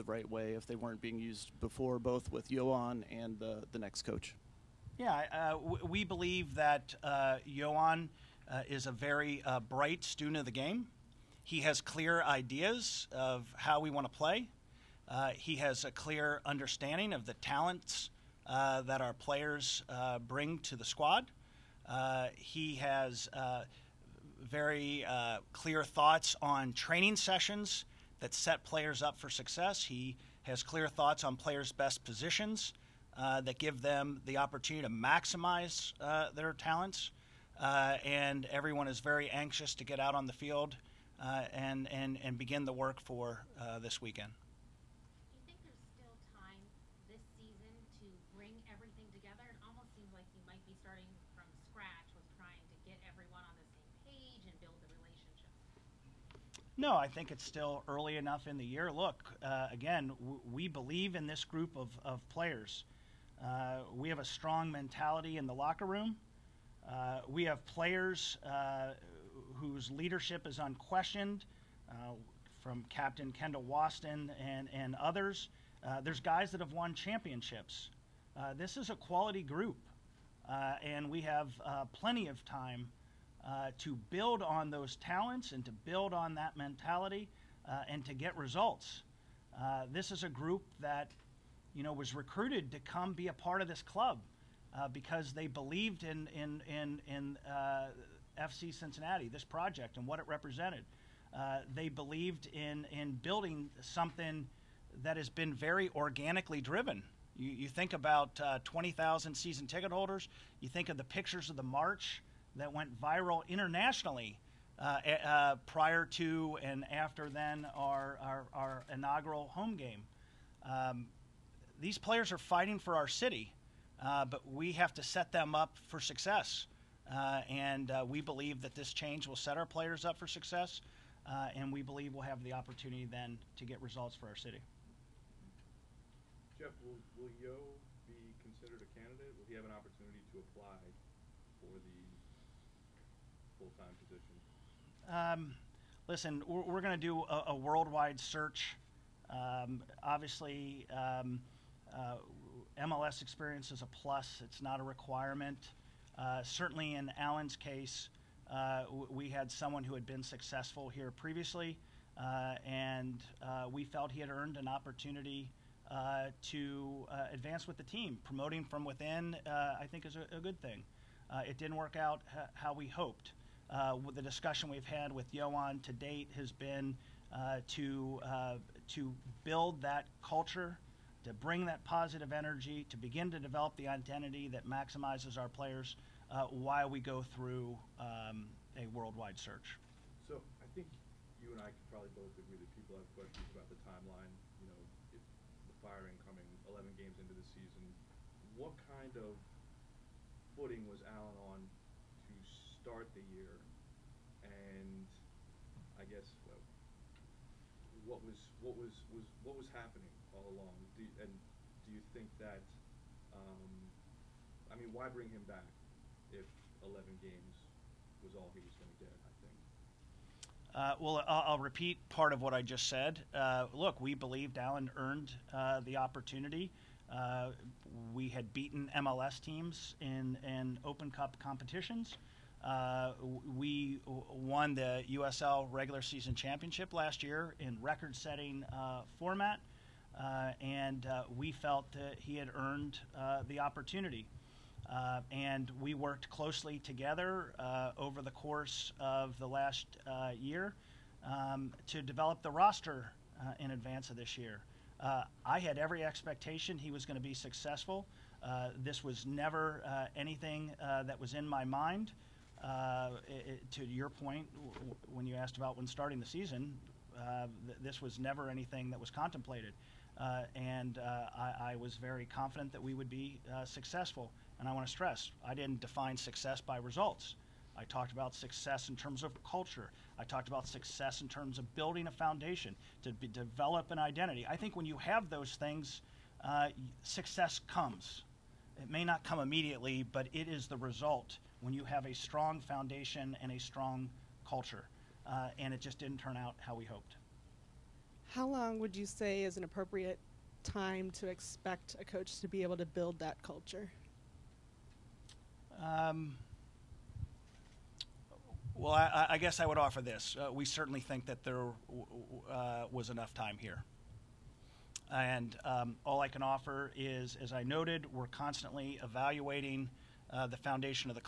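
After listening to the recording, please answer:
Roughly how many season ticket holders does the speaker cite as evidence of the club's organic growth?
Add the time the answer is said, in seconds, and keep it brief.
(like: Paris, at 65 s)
20,000, at 108 s.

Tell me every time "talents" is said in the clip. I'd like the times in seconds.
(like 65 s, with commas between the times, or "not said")
17 s, 36 s, 84 s.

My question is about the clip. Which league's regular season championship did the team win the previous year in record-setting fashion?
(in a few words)
USL.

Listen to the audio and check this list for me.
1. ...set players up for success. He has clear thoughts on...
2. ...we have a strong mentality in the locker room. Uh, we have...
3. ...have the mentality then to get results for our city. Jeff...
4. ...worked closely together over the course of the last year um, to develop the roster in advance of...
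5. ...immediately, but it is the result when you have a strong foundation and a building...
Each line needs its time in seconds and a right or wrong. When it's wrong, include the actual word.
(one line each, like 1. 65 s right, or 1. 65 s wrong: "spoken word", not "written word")
1. 28 s right
2. 63 s right
3. 132 s wrong: "opportunity", not "mentality"
4. 245 s right
5. 289 s wrong: "strong", not "building".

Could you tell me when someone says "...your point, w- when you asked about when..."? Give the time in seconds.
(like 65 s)
263 s.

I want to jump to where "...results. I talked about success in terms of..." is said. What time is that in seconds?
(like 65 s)
276 s.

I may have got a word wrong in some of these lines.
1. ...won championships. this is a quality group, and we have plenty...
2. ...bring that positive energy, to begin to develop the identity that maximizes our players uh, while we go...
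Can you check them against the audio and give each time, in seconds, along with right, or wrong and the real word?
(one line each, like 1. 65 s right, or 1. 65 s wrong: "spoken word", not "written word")
1. 76 s right
2. 181 s right.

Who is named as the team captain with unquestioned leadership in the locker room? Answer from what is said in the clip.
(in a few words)
Kendall Waston.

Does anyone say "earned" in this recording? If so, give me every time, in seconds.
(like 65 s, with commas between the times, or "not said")
164 s, 224 s, 242 s.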